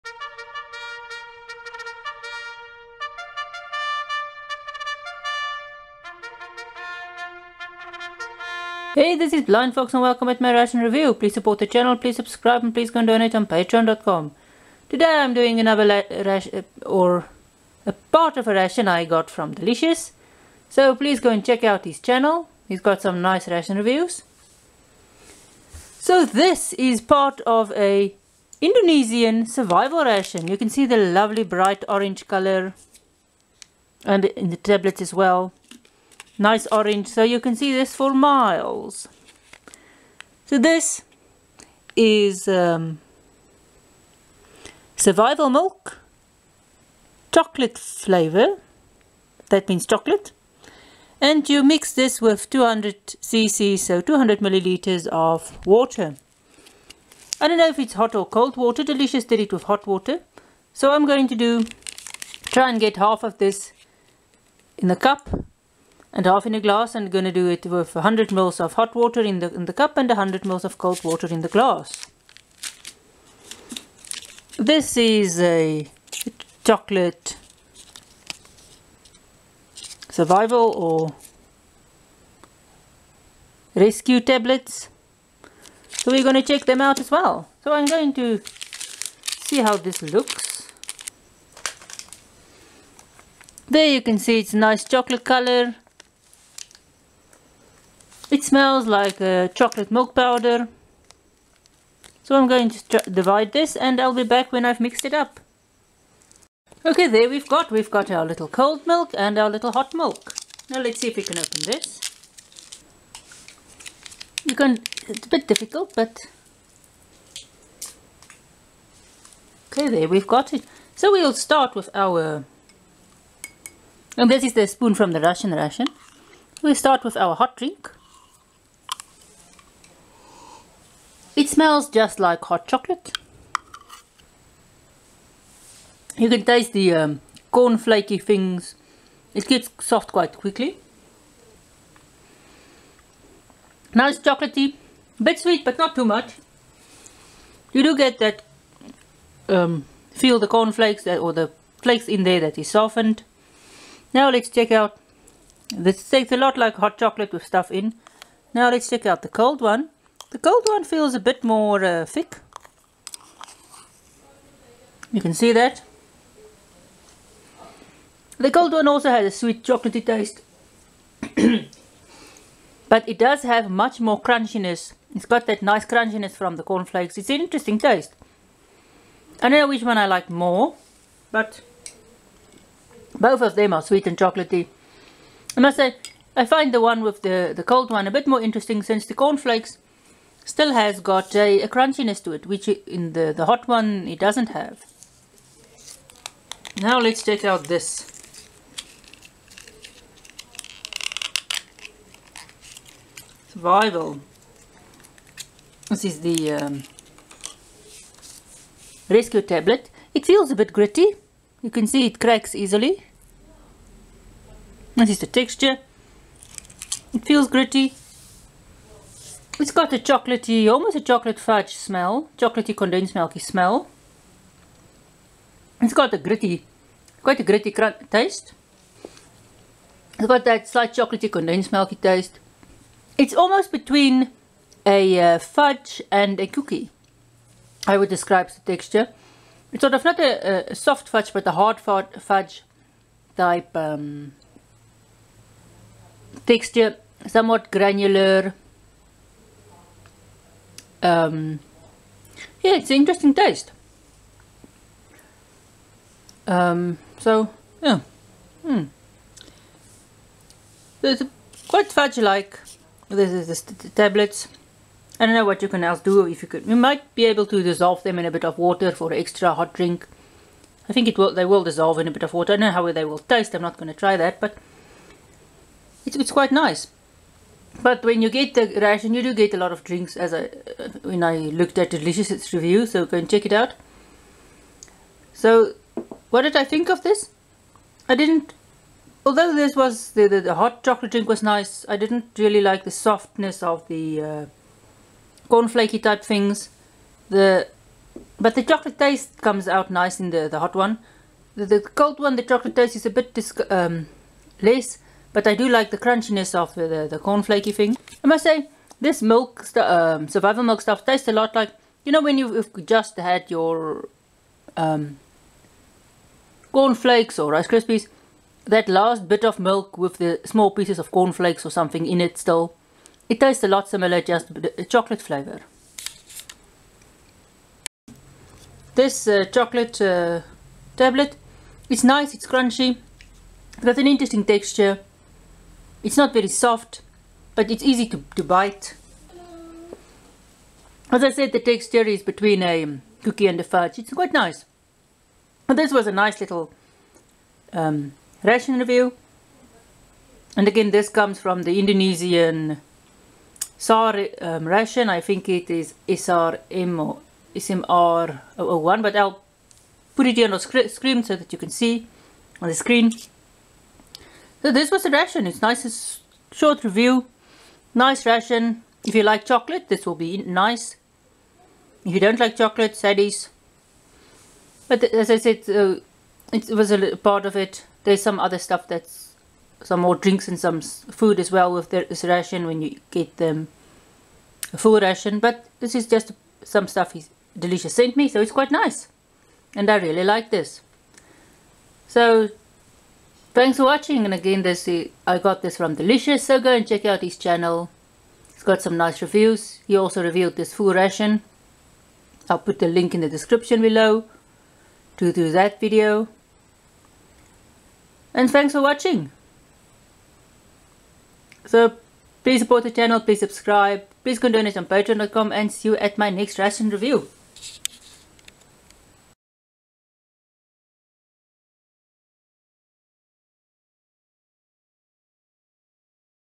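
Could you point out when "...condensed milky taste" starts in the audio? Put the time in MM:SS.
03:51.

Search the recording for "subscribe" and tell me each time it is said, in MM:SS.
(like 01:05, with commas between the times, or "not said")
00:12, 06:53.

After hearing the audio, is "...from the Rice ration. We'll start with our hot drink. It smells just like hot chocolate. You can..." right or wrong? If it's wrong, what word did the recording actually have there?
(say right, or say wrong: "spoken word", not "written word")
wrong: "Russian", not "Rice".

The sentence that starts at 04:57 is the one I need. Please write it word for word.
The but the chocolate taste comes out nice in the the hot one.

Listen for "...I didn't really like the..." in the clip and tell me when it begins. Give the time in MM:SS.
04:51.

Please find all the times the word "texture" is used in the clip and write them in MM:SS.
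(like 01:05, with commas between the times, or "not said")
03:35, 03:58, 04:06, 05:34, 05:41.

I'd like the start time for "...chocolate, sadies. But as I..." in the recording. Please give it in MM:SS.
06:12.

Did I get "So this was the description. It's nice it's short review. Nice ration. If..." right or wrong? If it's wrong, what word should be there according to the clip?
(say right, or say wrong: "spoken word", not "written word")
wrong: "ration", not "description".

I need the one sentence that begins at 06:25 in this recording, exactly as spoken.
But this is just some stuff he's Delicious sent me, so it's quite nice.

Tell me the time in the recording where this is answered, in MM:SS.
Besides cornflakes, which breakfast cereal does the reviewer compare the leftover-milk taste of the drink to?
05:17.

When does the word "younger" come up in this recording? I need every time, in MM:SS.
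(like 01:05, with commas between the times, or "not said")
not said.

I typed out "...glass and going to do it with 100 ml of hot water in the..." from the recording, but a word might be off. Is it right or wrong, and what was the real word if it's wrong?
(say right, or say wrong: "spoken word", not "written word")
right.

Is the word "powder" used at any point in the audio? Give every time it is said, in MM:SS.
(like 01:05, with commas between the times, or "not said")
01:40.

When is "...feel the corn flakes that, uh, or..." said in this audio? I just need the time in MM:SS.
02:30.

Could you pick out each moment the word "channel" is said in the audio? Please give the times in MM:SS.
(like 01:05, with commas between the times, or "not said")
00:11, 00:22, 06:37, 06:52.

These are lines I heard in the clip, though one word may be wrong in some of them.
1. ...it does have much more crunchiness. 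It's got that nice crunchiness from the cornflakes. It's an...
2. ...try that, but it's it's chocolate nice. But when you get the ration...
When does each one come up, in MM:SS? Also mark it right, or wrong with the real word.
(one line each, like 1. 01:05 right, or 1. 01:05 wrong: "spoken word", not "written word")
1. 02:53 right
2. 04:33 wrong: "quite", not "chocolate".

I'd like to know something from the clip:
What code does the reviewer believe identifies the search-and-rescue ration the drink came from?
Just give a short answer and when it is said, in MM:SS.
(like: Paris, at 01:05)
SRM or SMR001, at 05:56.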